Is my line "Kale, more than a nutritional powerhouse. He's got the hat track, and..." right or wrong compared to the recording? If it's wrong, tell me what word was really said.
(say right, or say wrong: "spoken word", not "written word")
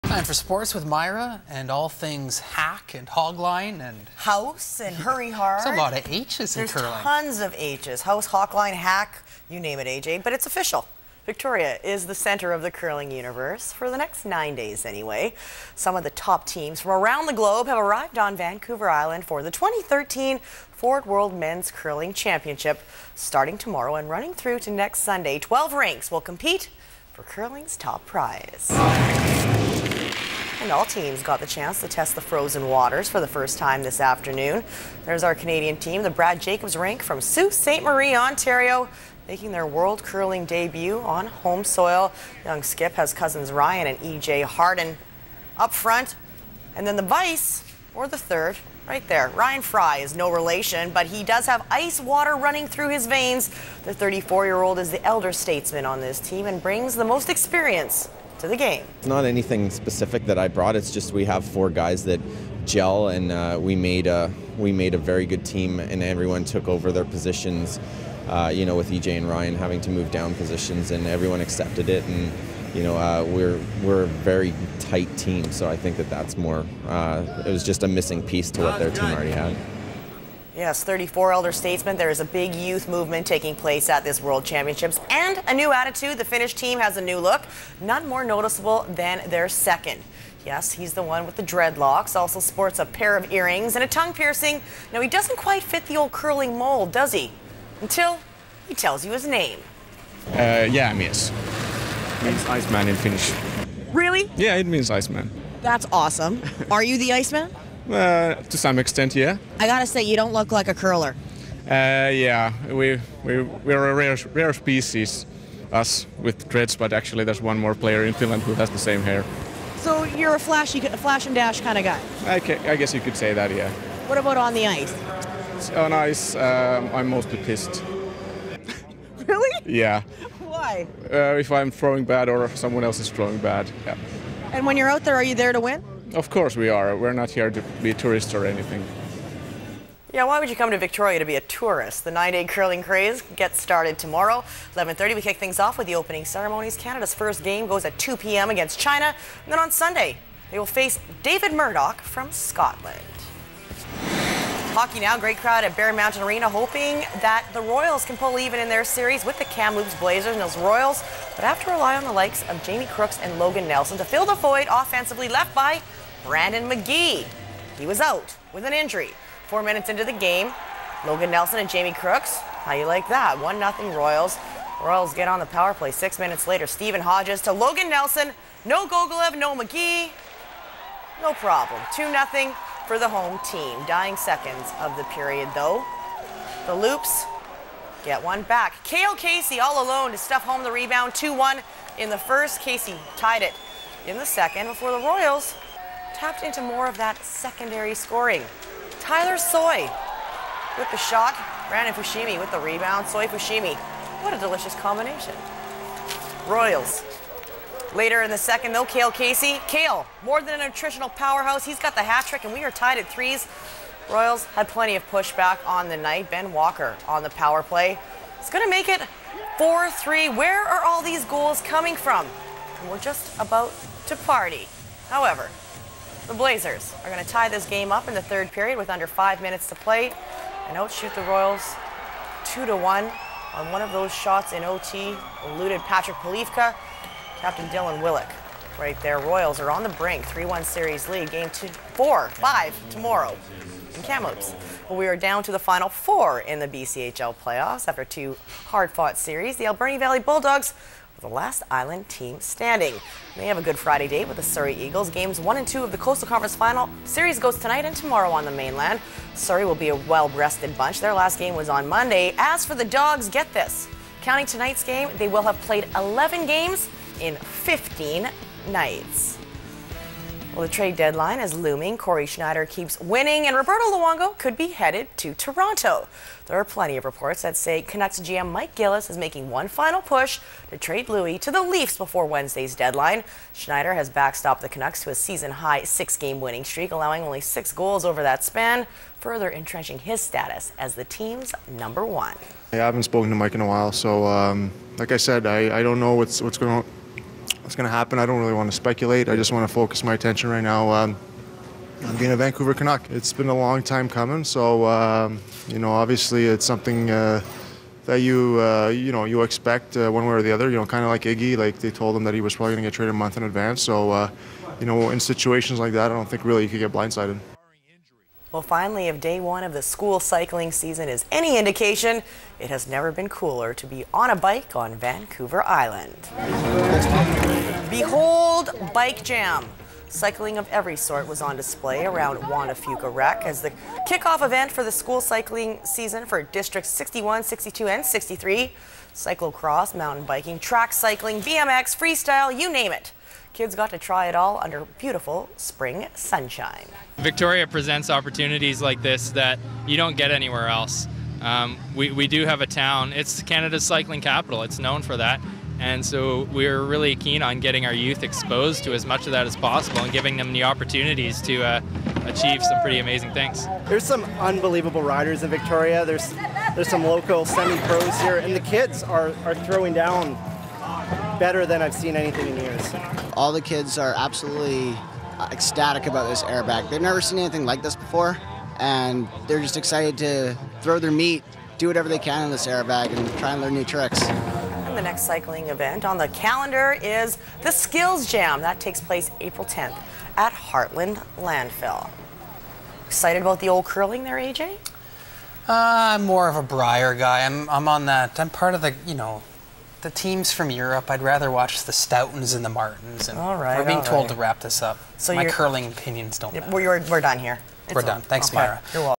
wrong: "trick", not "track".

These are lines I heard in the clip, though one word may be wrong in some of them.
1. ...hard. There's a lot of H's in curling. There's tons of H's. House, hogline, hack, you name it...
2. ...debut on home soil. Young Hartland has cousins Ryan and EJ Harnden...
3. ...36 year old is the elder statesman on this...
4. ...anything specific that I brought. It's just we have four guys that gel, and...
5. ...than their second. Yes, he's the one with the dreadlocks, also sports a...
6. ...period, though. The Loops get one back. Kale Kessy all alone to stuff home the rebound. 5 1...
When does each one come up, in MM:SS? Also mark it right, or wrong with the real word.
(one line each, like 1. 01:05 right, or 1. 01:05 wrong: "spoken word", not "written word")
1. 00:05 right
2. 00:40 wrong: "Skip", not "Hartland"
3. 00:53 wrong: "34", not "36"
4. 00:59 right
5. 01:28 right
6. 03:05 wrong: "2", not "5".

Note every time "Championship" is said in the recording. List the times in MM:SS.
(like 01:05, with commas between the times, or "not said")
00:22, 01:24.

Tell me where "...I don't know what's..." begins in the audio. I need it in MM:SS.
04:55.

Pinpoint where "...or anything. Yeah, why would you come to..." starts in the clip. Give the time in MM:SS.
02:18.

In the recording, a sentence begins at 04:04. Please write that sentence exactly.
Well, we are down to the final four in the BCHL playoffs after two hard-fought series.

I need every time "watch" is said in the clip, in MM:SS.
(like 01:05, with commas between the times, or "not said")
06:41.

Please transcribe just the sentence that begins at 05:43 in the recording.
Kids got to try it all under beautiful spring sunshine.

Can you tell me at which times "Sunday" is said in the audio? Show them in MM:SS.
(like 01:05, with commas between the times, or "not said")
00:25, 02:29.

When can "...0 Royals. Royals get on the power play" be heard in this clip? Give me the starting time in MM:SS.
02:53.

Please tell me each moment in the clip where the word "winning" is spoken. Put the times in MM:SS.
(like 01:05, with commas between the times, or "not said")
04:32, 04:46.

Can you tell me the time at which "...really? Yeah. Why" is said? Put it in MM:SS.
02:09.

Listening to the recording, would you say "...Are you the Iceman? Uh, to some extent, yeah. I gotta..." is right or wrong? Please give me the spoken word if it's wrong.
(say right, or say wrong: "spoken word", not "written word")
right.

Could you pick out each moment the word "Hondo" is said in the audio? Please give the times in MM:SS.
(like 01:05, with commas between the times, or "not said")
not said.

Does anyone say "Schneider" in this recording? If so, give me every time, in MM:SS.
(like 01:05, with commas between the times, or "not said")
04:32, 04:43.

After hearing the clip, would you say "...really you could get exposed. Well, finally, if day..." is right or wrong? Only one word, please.
wrong.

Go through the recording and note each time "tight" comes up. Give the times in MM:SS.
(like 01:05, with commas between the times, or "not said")
01:14.